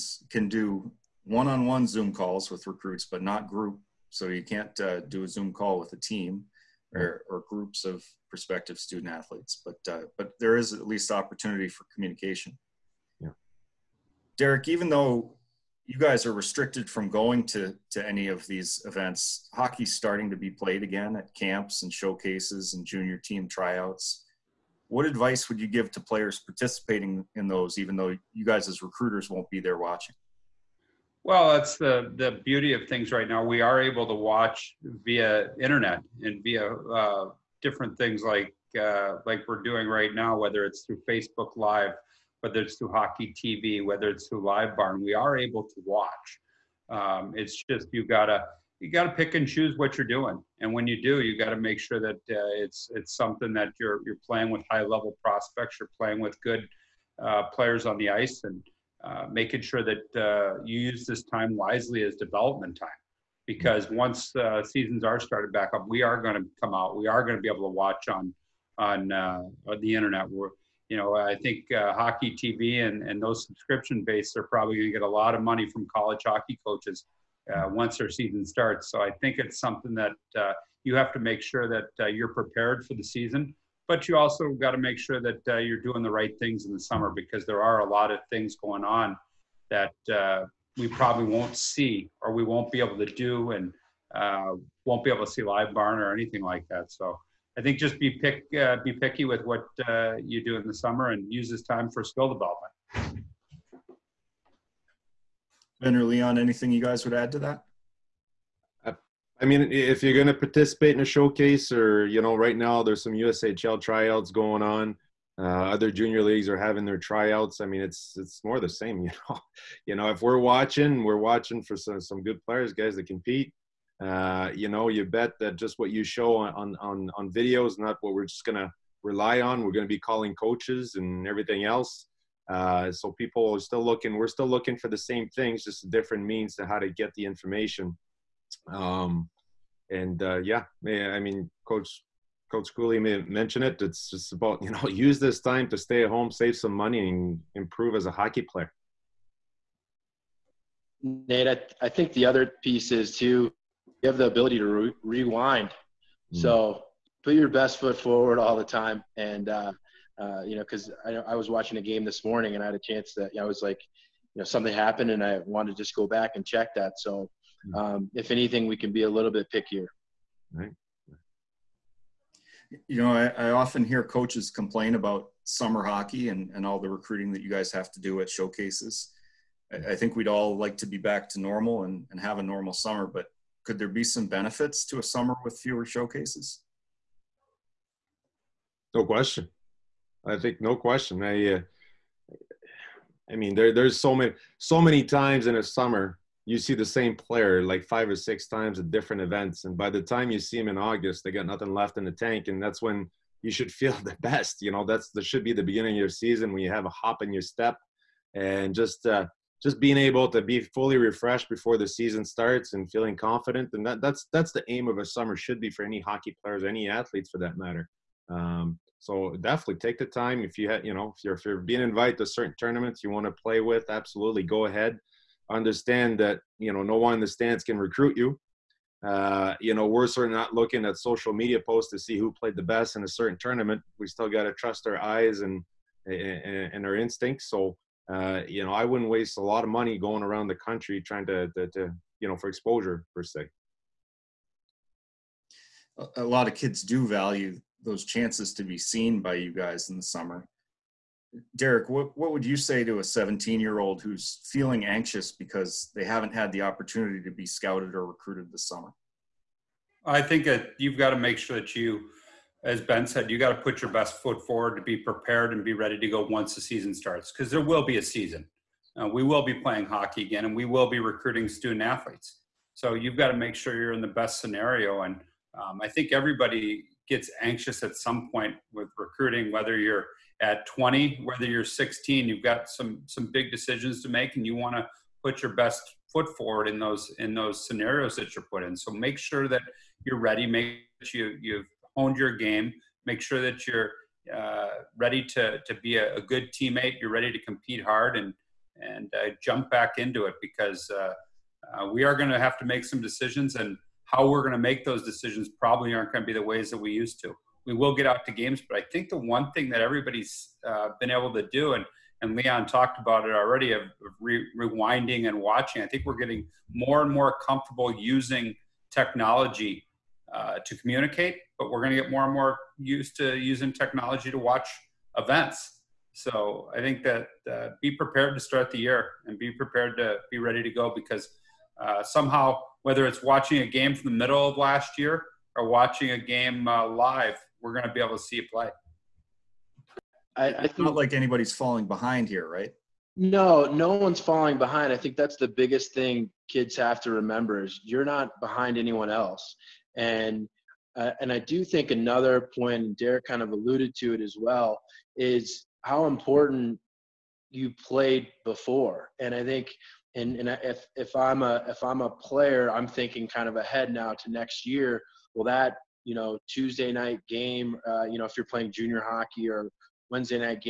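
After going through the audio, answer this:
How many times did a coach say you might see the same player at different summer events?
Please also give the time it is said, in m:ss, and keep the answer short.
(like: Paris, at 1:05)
5 or 6, at 3:17.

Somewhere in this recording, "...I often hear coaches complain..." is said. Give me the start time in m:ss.
2:53.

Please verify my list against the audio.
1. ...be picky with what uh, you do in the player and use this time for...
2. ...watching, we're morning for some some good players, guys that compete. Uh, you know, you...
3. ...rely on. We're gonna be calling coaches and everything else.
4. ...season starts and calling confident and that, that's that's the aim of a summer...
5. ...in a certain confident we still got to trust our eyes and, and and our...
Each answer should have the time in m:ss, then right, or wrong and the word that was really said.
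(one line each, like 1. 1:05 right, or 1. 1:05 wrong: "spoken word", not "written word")
1. 1:38 wrong: "summer", not "player"
2. 2:00 wrong: "watching", not "morning"
3. 2:09 right
4. 3:31 wrong: "feeling", not "calling"
5. 3:52 wrong: "tournament", not "confident".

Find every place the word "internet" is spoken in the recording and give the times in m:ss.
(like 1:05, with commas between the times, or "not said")
0:35, 1:09.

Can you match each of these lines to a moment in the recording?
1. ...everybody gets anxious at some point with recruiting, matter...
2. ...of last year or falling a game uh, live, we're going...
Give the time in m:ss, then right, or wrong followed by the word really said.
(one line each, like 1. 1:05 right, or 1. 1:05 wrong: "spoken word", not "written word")
1. 4:36 wrong: "whether", not "matter"
2. 5:34 wrong: "watching", not "falling".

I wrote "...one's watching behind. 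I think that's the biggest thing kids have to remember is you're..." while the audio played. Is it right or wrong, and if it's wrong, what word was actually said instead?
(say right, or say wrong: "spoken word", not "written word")
wrong: "falling", not "watching".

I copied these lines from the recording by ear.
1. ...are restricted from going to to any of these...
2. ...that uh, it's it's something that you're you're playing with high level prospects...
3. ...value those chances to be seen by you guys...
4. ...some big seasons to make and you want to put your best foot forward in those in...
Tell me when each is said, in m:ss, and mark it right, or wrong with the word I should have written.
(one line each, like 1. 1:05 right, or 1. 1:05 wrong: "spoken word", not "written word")
1. 0:16 right
2. 0:51 right
3. 4:07 right
4. 4:43 wrong: "decisions", not "seasons".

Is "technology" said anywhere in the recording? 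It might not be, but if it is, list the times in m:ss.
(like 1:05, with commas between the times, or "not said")
5:18, 5:23.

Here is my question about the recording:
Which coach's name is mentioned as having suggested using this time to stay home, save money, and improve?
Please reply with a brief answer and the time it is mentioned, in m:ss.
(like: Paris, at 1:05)
Coach Schooley, at 2:22.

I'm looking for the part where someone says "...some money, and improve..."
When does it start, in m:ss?
2:26.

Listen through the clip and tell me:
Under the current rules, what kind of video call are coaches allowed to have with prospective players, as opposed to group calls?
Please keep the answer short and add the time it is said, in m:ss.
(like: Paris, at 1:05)
one-on-one Zoom calls, at 0:01.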